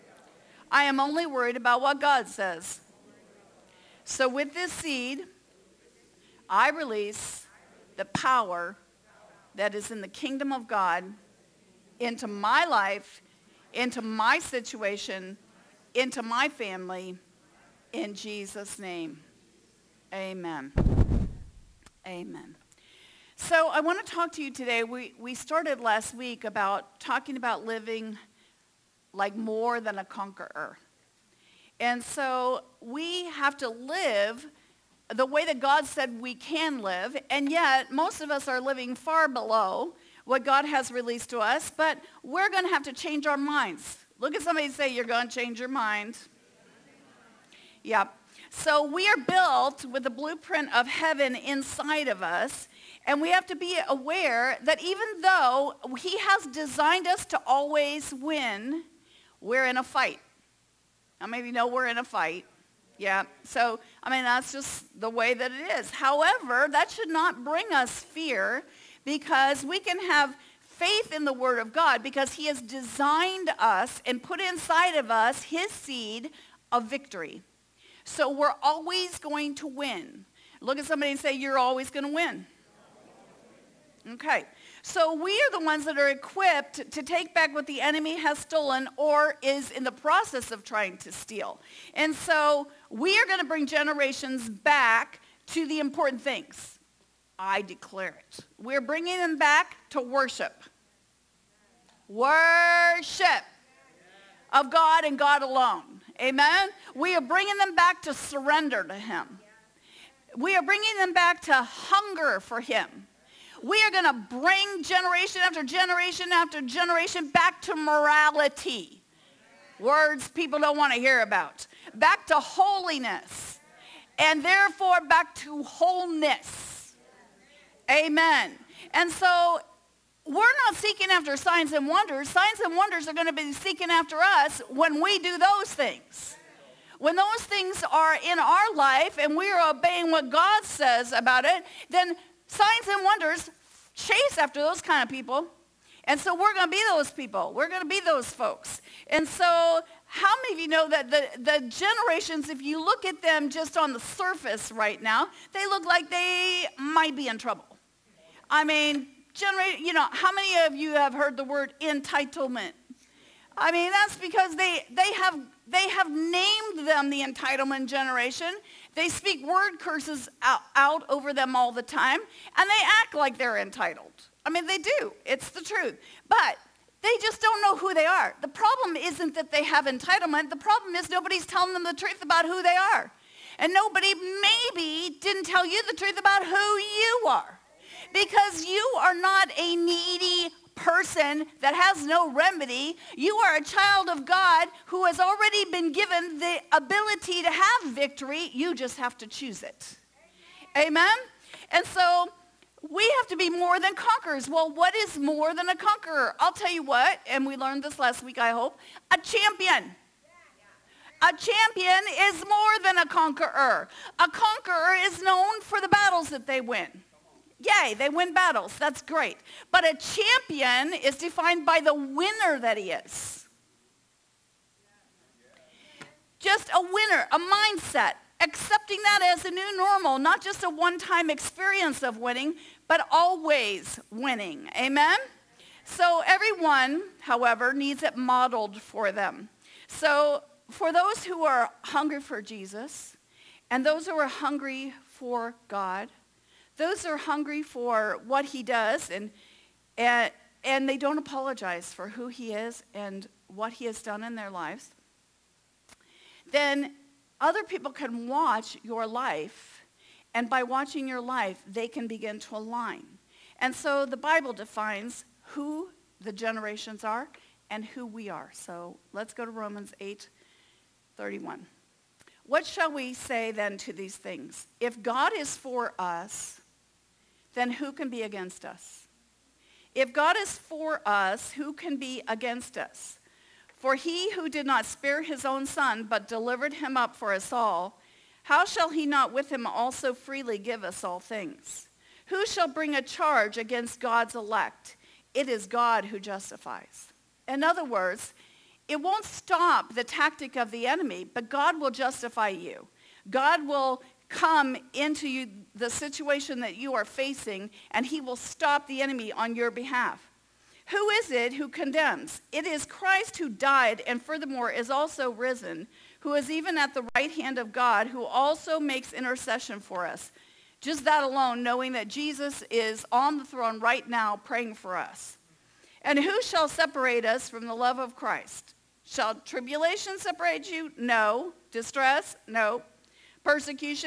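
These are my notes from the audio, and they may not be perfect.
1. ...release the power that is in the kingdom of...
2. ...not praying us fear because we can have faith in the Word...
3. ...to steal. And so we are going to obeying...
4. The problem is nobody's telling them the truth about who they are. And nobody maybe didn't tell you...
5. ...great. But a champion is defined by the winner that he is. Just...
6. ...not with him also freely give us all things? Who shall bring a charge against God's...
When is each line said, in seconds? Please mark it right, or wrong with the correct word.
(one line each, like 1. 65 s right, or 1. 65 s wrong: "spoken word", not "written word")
1. 6 s right
2. 67 s wrong: "bring", not "praying"
3. 90 s wrong: "bring", not "obeying"
4. 180 s right
5. 219 s right
6. 289 s right.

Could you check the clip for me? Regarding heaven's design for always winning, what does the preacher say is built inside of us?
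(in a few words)
the blueprint of heaven.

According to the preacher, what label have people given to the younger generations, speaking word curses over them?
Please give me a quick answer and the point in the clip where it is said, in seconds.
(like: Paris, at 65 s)
the entitlement generation, at 167 s.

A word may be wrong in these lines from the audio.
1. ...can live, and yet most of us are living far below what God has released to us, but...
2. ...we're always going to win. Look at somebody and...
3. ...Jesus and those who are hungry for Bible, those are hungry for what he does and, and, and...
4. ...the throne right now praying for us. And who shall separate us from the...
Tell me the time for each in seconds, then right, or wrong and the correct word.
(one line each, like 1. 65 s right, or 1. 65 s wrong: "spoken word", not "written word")
1. 36 s right
2. 78 s right
3. 242 s wrong: "God", not "Bible"
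4. 323 s right.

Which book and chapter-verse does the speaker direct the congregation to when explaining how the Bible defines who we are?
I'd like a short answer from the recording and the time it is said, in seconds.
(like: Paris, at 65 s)
Romans 8:31, at 269 s.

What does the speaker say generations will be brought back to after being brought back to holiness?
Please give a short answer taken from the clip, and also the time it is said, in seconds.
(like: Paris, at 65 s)
wholeness, at 125 s.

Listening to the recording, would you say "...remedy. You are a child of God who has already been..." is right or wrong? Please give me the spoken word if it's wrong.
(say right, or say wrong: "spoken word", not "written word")
right.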